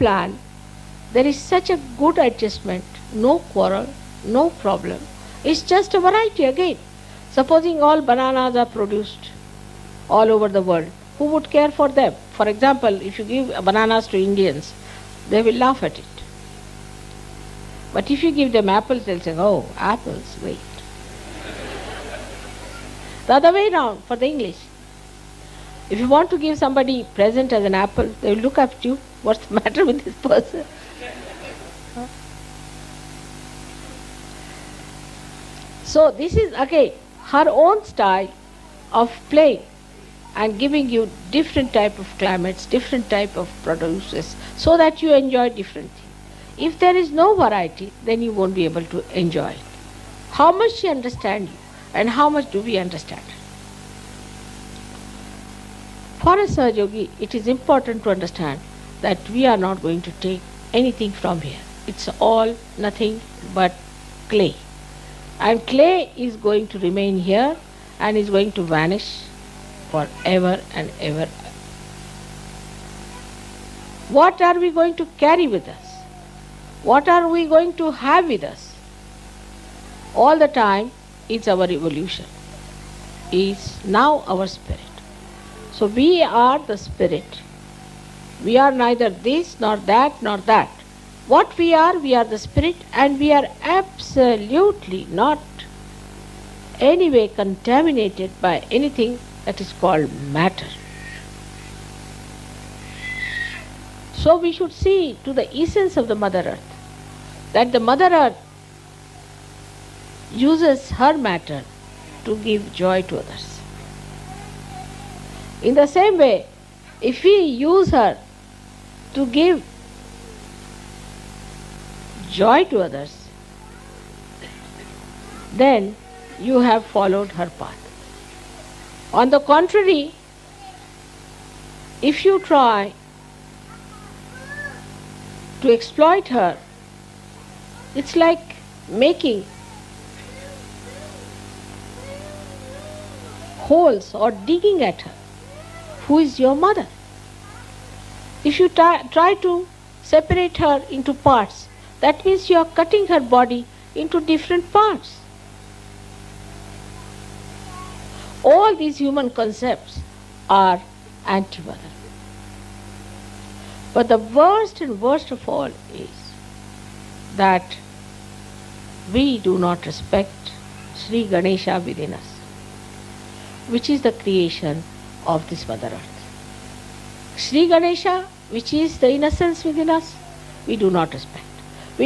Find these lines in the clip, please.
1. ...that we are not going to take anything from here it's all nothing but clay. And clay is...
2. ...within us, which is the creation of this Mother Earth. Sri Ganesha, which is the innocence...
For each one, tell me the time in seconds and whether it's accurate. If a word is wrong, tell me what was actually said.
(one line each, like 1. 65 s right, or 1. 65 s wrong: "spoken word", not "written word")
1. 59 s right
2. 171 s right.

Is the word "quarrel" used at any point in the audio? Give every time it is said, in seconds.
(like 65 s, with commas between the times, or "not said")
3 s.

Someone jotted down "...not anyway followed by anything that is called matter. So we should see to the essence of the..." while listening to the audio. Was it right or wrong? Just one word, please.
wrong.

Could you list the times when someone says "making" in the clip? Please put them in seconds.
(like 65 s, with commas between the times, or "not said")
138 s.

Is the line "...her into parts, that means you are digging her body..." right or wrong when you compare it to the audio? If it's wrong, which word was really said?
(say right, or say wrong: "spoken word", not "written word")
wrong: "cutting", not "digging".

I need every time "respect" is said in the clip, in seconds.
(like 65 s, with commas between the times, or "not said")
169 s, 181 s.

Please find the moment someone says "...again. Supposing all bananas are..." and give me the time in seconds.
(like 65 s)
6 s.